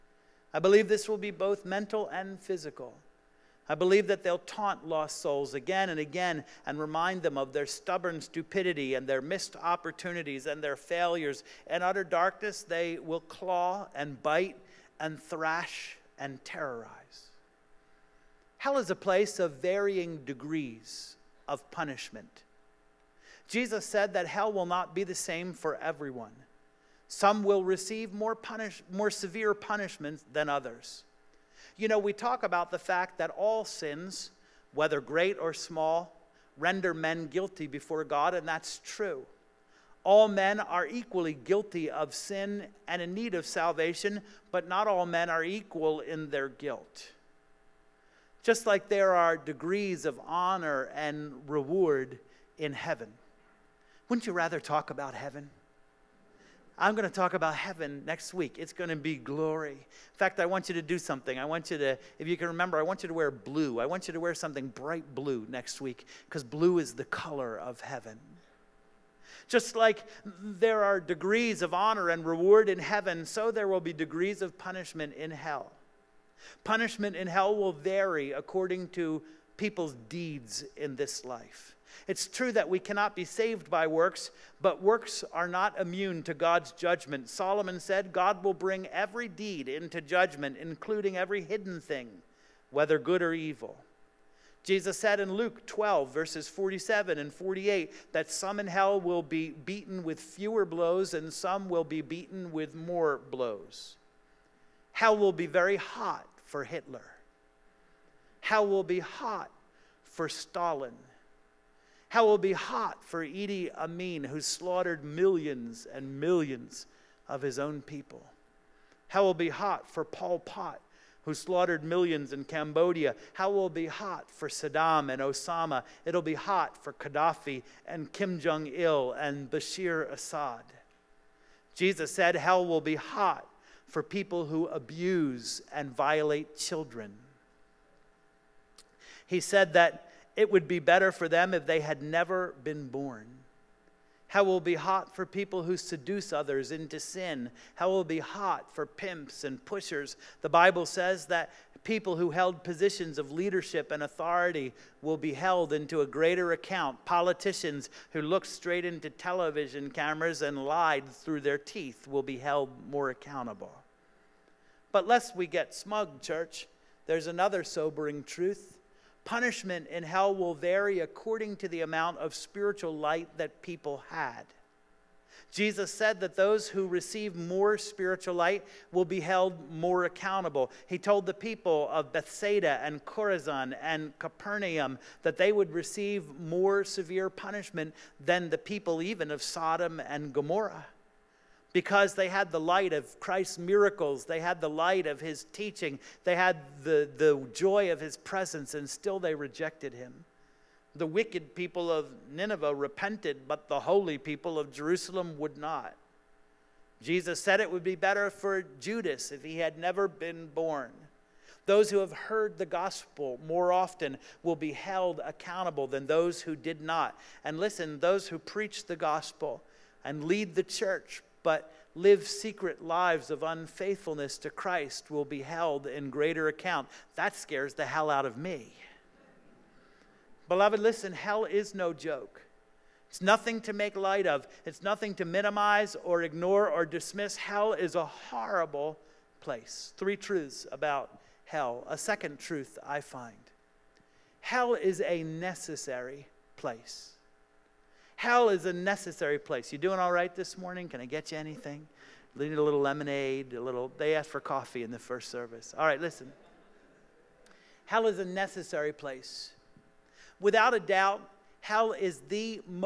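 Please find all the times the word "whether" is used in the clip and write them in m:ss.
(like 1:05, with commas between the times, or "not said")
0:34, 1:32.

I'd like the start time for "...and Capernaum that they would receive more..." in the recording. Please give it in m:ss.
3:03.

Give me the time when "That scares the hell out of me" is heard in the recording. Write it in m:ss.
3:47.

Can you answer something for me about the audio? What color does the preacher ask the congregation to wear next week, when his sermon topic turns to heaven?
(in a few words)
bright blue.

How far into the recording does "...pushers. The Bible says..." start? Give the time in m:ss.
2:29.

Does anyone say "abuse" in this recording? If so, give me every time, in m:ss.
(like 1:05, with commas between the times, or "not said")
2:14.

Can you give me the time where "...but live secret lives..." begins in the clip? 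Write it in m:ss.
3:41.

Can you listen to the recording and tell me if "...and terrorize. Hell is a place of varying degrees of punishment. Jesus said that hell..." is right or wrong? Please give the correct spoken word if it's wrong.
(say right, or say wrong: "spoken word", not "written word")
right.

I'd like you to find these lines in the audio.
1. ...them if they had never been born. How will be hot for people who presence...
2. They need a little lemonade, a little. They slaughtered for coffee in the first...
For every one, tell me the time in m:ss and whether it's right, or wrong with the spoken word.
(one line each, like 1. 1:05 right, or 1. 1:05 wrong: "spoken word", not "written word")
1. 2:21 wrong: "seduce", not "presence"
2. 4:12 wrong: "asked", not "slaughtered".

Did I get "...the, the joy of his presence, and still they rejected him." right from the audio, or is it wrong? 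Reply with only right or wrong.
right.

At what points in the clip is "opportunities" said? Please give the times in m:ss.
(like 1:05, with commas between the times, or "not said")
0:09.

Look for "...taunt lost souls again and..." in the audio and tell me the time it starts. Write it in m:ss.
0:04.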